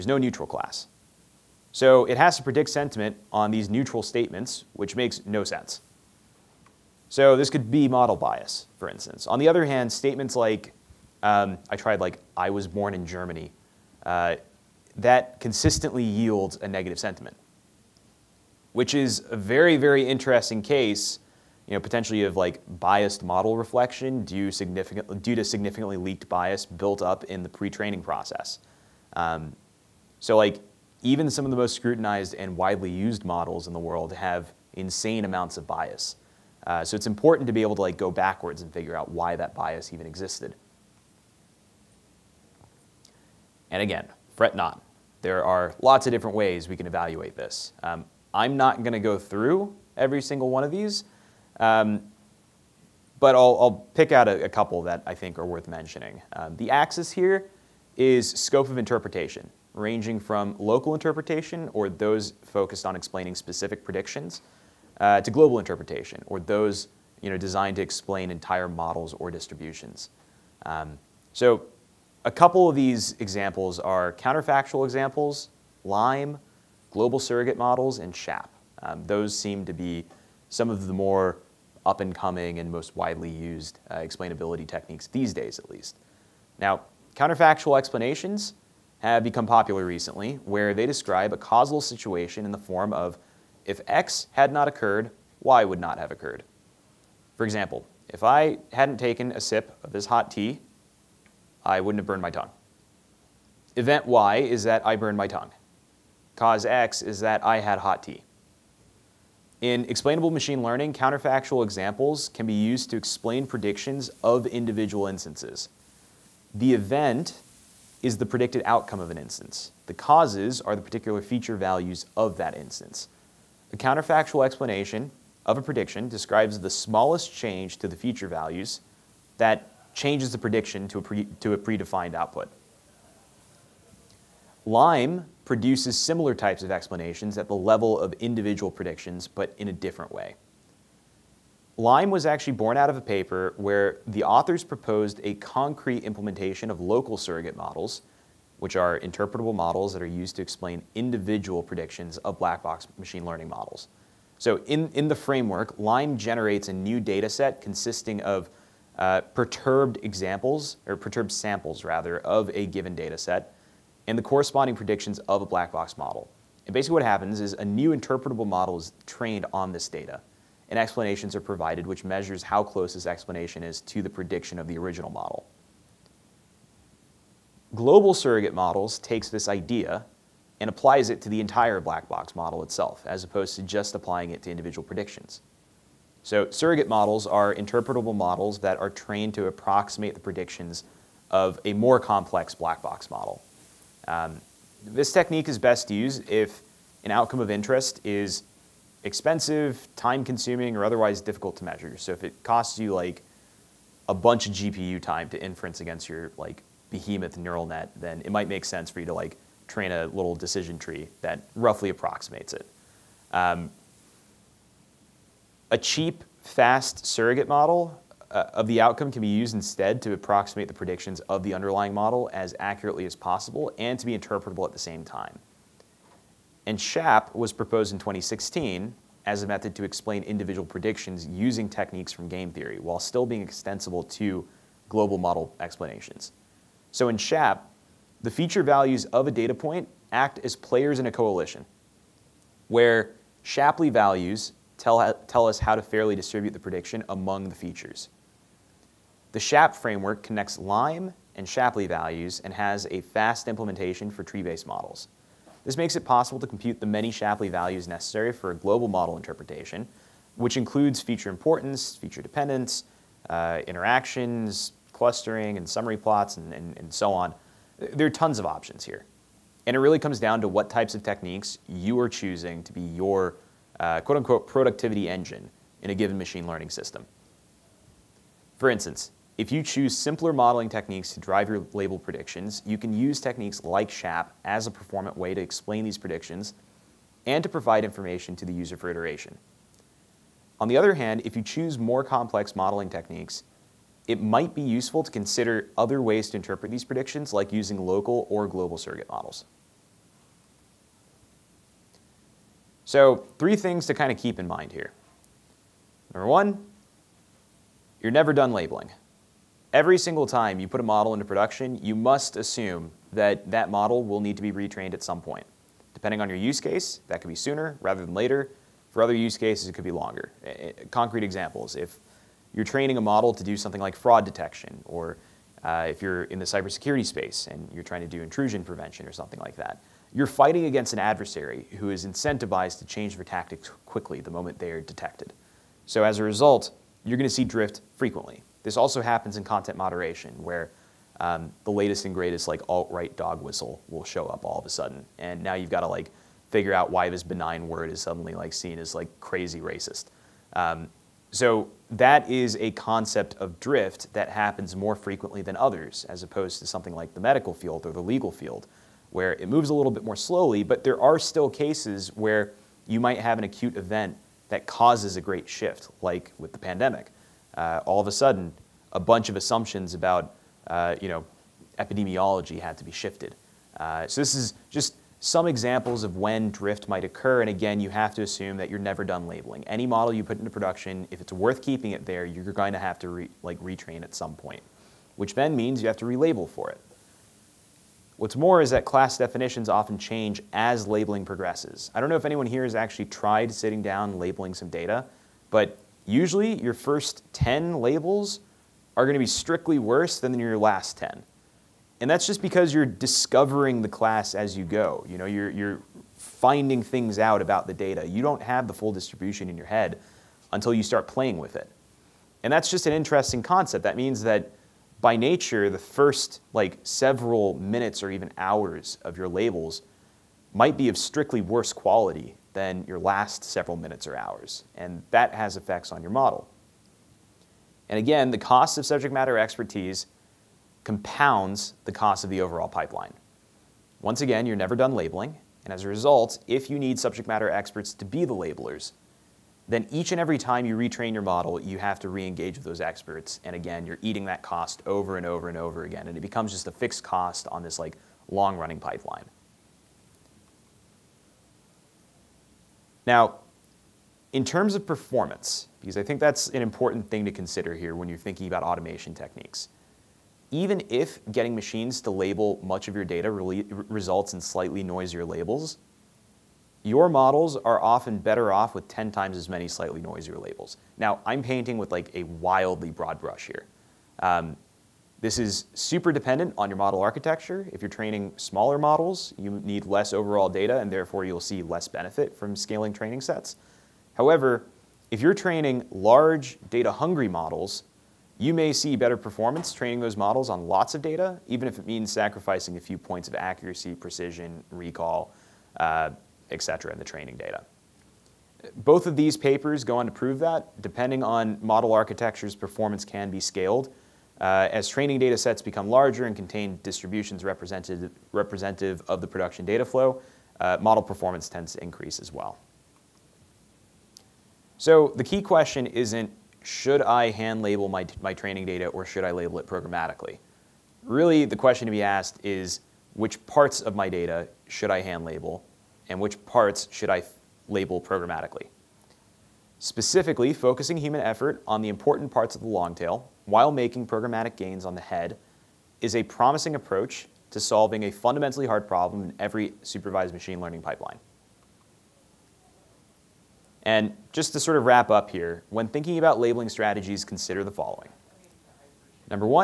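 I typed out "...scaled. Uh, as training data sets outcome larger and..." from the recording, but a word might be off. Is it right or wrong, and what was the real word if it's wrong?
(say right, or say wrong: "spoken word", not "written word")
wrong: "become", not "outcome".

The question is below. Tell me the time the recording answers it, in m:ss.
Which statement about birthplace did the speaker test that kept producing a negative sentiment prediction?
0:12.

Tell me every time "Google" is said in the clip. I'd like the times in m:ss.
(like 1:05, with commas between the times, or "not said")
not said.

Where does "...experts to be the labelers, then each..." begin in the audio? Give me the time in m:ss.
7:17.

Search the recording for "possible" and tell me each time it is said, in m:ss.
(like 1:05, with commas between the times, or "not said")
3:43, 4:16.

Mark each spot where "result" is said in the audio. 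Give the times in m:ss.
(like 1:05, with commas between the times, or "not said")
5:36, 7:15, 7:43.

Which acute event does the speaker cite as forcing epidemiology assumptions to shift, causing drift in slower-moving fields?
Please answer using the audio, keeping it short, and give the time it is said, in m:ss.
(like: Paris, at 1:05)
the pandemic, at 6:06.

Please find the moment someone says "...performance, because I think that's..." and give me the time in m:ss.
7:34.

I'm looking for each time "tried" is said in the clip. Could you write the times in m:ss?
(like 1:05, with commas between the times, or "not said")
0:11, 6:33.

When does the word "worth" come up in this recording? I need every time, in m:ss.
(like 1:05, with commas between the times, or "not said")
0:55, 6:21.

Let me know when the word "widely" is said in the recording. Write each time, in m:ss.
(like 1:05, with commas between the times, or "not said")
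0:32, 1:22.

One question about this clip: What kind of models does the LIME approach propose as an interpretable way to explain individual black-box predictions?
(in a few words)
local surrogate models.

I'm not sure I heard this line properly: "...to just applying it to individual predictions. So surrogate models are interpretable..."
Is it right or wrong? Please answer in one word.
right.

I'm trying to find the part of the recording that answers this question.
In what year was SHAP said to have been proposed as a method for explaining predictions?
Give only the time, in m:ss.
3:47.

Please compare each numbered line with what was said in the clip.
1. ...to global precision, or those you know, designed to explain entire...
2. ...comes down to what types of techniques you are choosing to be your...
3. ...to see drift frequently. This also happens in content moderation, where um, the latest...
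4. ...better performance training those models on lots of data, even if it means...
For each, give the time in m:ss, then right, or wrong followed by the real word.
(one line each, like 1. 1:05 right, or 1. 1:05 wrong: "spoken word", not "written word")
1. 1:05 wrong: "interpretation", not "precision"
2. 4:29 right
3. 5:37 right
4. 8:08 right.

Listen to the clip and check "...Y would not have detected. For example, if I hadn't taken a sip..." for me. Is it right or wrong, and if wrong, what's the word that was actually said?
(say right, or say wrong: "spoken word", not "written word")
wrong: "occurred", not "detected".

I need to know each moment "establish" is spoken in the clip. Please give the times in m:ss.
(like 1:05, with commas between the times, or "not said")
not said.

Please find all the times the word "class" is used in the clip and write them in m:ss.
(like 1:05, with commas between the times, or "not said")
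0:00, 6:28, 6:43.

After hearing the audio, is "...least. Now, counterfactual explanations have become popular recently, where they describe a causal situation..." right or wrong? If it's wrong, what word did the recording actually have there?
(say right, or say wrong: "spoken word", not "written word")
right.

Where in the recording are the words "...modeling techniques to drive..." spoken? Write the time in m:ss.
4:40.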